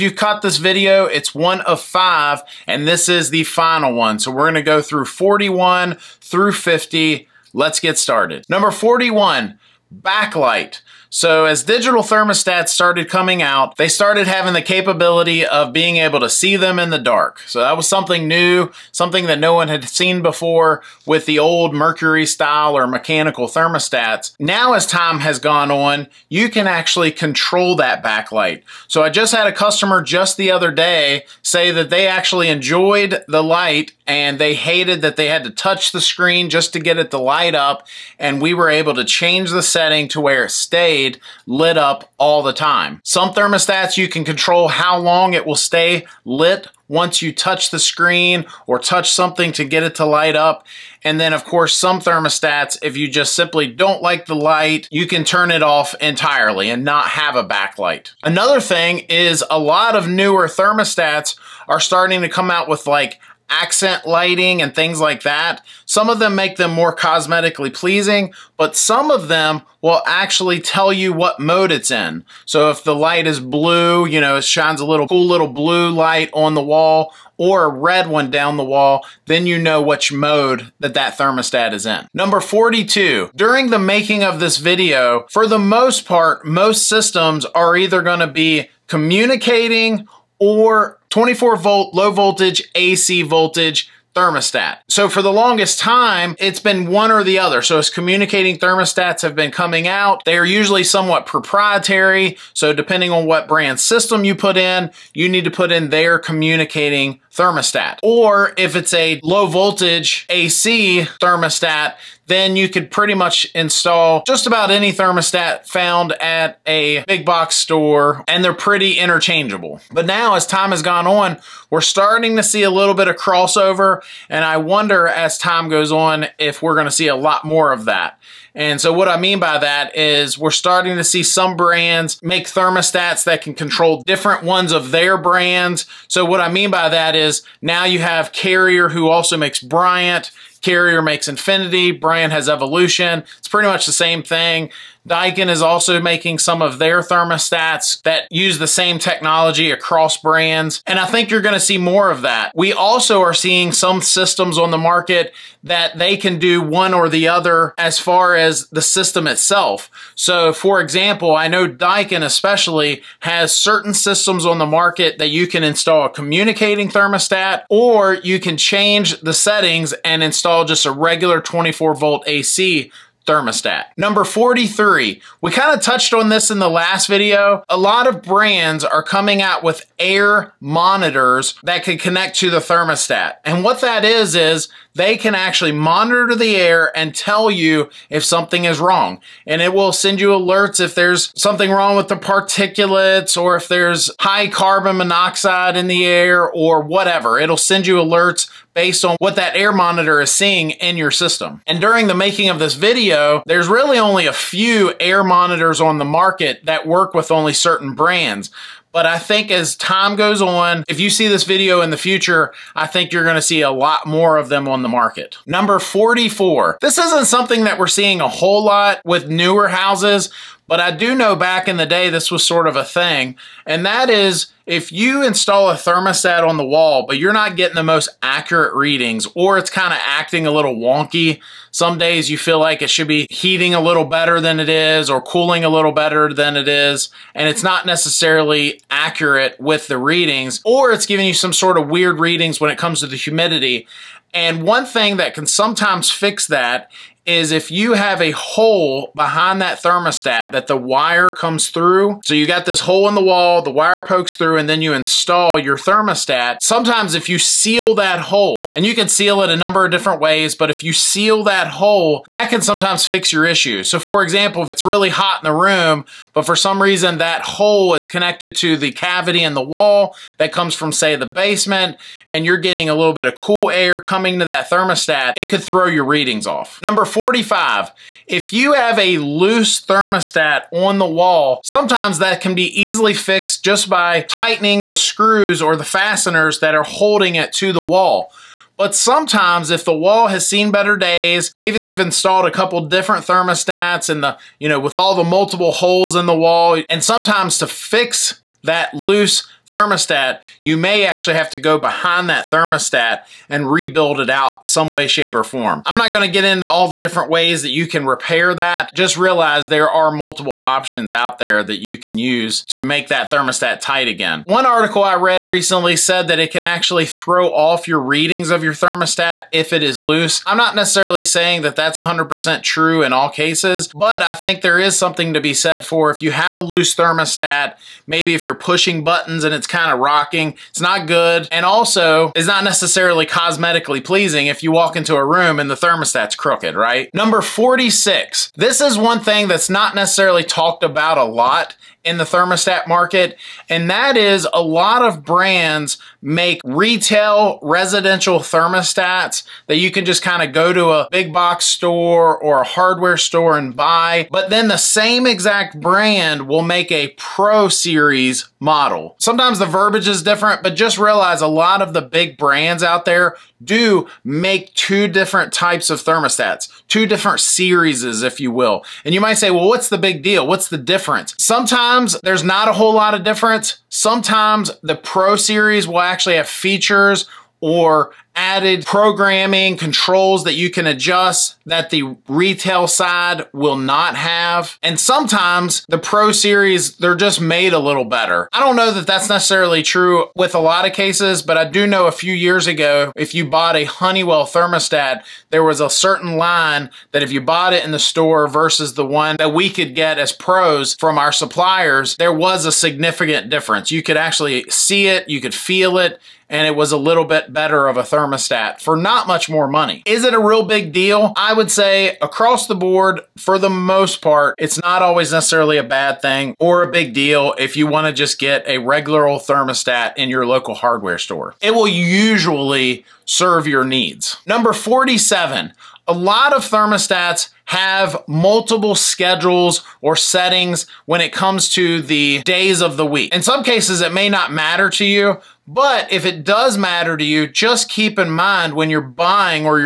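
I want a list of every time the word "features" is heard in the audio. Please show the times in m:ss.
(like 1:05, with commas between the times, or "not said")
6:16.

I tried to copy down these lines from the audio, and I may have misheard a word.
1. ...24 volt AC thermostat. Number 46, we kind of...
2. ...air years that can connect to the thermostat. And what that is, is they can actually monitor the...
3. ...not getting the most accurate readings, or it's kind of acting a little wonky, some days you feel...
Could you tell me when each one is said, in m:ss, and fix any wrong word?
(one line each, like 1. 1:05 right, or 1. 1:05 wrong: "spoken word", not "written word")
1. 2:51 wrong: "43", not "46"
2. 2:59 wrong: "monitors", not "years"
3. 3:47 right.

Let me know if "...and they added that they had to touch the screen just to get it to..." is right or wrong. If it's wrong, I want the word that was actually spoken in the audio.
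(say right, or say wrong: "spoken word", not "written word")
wrong: "hated", not "added".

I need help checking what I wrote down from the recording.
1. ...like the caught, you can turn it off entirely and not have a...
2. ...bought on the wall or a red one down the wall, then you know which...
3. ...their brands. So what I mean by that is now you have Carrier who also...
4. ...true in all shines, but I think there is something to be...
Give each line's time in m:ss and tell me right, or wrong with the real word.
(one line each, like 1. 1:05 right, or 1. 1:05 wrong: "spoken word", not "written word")
1. 0:54 wrong: "light", not "caught"
2. 1:15 wrong: "light", not "bought"
3. 2:14 right
4. 5:22 wrong: "cases", not "shines".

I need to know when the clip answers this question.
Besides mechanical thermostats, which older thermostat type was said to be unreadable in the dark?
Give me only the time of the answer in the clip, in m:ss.
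0:21.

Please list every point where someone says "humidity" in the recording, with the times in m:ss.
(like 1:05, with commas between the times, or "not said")
4:03.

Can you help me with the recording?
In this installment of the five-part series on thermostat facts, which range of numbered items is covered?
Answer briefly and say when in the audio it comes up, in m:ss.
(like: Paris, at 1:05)
41 through 50, at 0:05.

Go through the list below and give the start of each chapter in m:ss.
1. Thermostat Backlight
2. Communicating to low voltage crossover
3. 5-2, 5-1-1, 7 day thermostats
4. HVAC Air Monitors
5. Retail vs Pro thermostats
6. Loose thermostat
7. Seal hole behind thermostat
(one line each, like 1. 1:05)
1. 0:08
2. 1:21
3. 7:04
4. 2:53
5. 5:36
6. 4:36
7. 3:35.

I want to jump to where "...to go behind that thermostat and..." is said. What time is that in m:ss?
5:01.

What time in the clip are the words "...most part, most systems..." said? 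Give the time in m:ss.
1:25.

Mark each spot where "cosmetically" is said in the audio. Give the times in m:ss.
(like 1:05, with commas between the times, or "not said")
1:06, 5:33.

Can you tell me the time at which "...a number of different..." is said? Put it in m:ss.
4:19.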